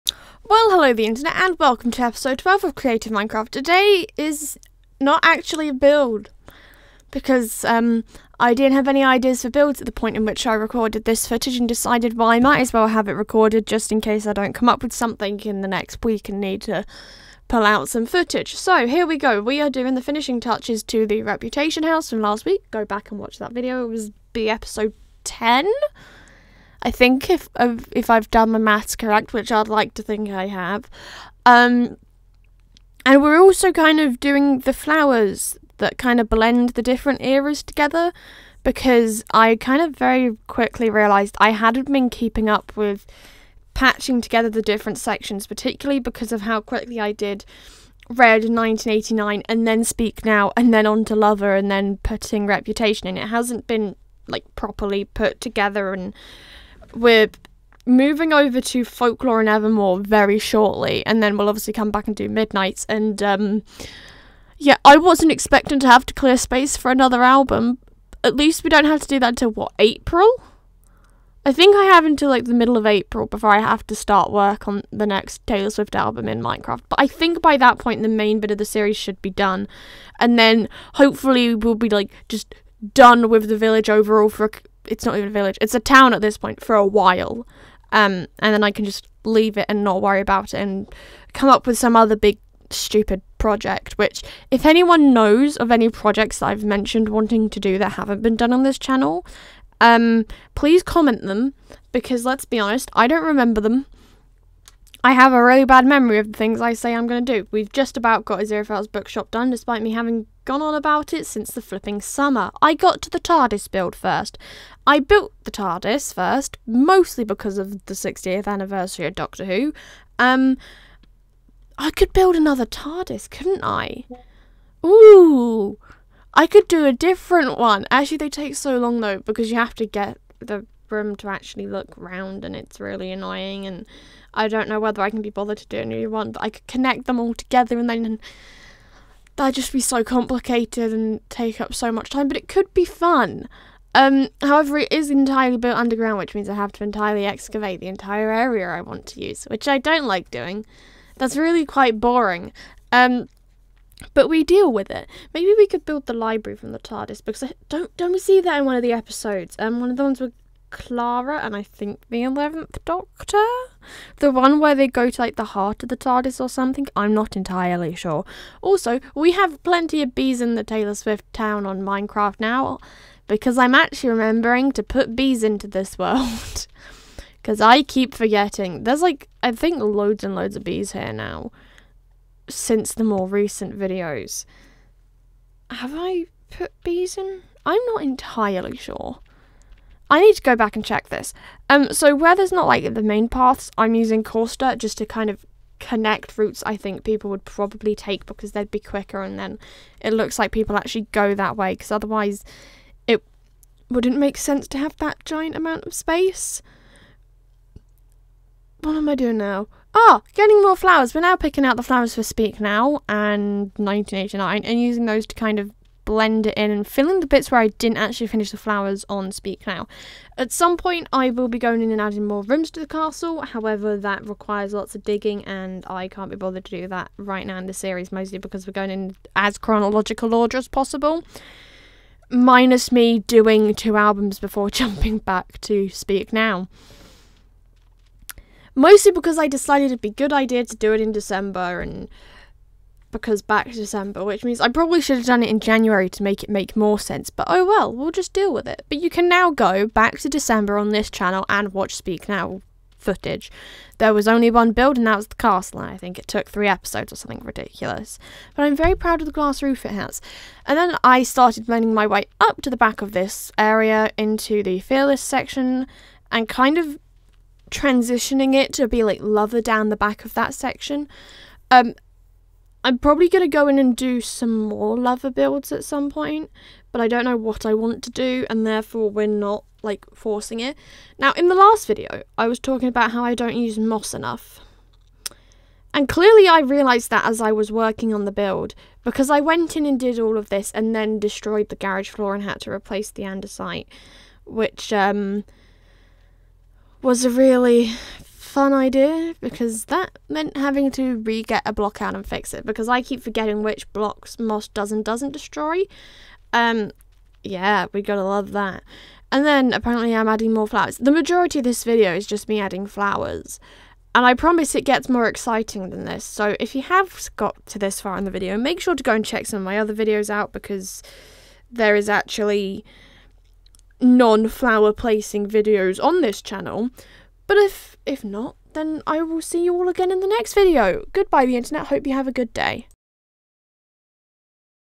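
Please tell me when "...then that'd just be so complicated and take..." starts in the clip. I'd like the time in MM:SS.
02:17.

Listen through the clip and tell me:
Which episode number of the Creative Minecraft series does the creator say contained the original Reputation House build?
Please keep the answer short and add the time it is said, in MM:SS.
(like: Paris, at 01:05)
10, at 00:24.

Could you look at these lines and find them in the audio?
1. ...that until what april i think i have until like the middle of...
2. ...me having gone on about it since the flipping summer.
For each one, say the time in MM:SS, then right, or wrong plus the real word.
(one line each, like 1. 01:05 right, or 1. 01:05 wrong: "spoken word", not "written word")
1. 01:09 right
2. 01:49 right.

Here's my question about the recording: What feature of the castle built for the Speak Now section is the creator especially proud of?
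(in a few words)
The glass roof.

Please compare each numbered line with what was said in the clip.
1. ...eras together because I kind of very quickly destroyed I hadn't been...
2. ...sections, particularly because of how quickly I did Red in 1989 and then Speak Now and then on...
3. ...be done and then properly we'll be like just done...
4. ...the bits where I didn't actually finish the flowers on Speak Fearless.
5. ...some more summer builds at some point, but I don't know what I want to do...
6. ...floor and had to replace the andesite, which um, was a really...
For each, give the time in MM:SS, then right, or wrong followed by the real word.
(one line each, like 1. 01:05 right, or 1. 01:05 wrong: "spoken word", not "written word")
1. 00:37 wrong: "realized", not "destroyed"
2. 00:44 right
3. 01:19 wrong: "hopefully", not "properly"
4. 03:37 wrong: "Now", not "Fearless"
5. 04:34 wrong: "lover", not "summer"
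6. 04:52 right.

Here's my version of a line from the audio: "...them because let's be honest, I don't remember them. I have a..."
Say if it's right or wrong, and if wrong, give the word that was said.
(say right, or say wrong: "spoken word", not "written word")
right.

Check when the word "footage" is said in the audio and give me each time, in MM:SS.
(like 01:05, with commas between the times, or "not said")
00:11, 00:18, 04:12.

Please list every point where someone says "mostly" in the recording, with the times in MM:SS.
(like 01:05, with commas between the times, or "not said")
01:56, 03:48, 03:58.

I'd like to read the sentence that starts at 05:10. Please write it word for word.
The majority of this video is just me adding flowers.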